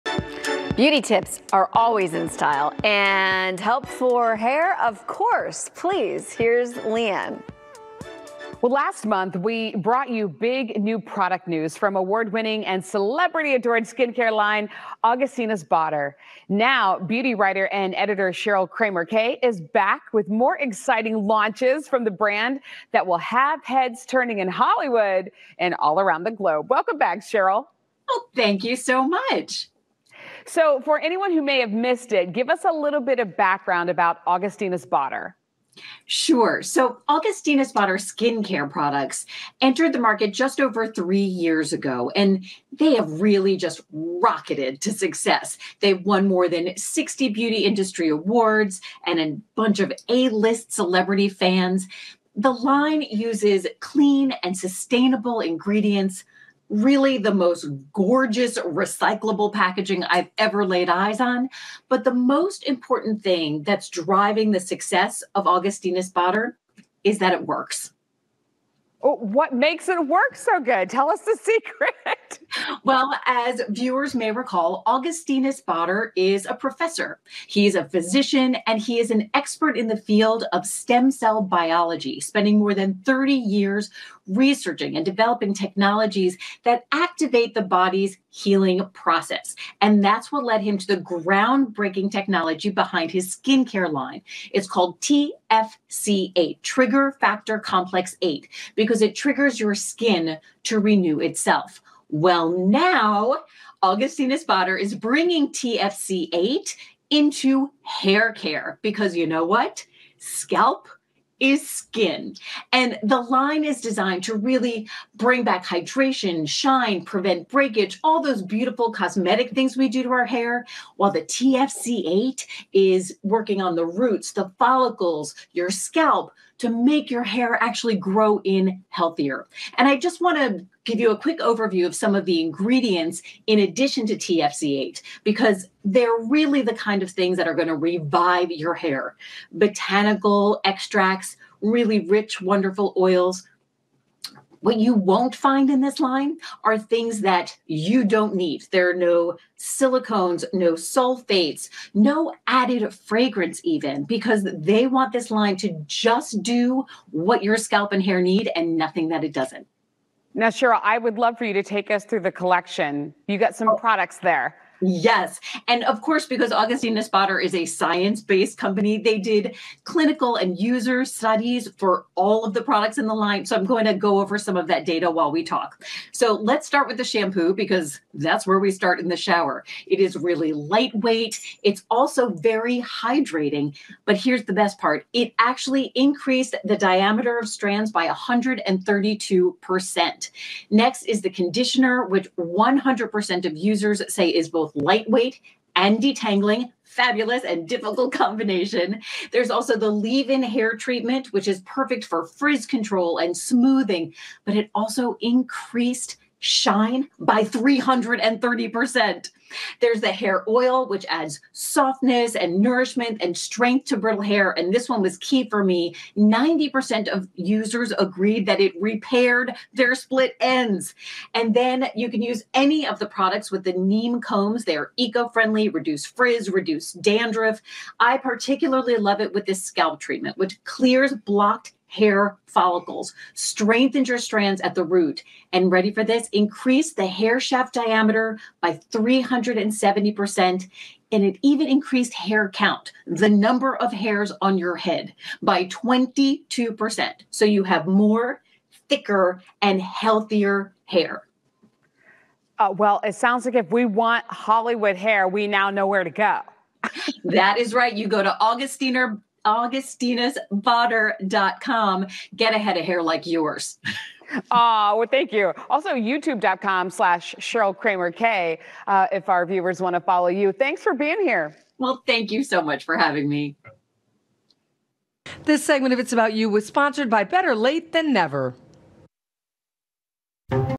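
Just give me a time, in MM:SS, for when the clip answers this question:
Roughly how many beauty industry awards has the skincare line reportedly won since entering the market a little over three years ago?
00:46.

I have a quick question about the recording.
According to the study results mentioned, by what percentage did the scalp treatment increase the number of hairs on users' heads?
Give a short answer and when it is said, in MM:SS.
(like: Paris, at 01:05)
22%, at 04:05.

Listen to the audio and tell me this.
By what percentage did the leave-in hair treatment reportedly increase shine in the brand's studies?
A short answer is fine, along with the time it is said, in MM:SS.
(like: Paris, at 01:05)
330%, at 03:27.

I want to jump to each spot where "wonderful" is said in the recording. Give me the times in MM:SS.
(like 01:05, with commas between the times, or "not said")
02:22.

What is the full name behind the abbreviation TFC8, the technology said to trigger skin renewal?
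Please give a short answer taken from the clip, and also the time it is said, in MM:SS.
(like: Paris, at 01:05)
Trigger Factor Complex 8, at 01:36.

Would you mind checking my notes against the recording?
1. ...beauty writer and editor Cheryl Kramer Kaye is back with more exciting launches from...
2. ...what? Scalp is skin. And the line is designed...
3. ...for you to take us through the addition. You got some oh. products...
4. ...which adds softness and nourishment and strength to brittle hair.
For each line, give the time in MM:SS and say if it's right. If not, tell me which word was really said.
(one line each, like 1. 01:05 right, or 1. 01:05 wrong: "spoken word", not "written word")
1. 00:16 right
2. 01:49 right
3. 02:41 wrong: "collection", not "addition"
4. 03:30 right.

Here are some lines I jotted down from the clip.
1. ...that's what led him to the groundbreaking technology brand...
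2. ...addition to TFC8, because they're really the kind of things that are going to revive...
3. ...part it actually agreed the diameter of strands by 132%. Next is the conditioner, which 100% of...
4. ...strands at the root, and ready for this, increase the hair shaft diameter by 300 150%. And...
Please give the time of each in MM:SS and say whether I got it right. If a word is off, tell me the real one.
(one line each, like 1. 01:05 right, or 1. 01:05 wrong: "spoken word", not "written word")
1. 01:30 wrong: "behind", not "brand"
2. 02:13 right
3. 03:04 wrong: "increased", not "agreed"
4. 03:54 wrong: "170", not "150".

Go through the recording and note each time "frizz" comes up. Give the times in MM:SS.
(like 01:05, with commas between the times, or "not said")
03:22, 03:46.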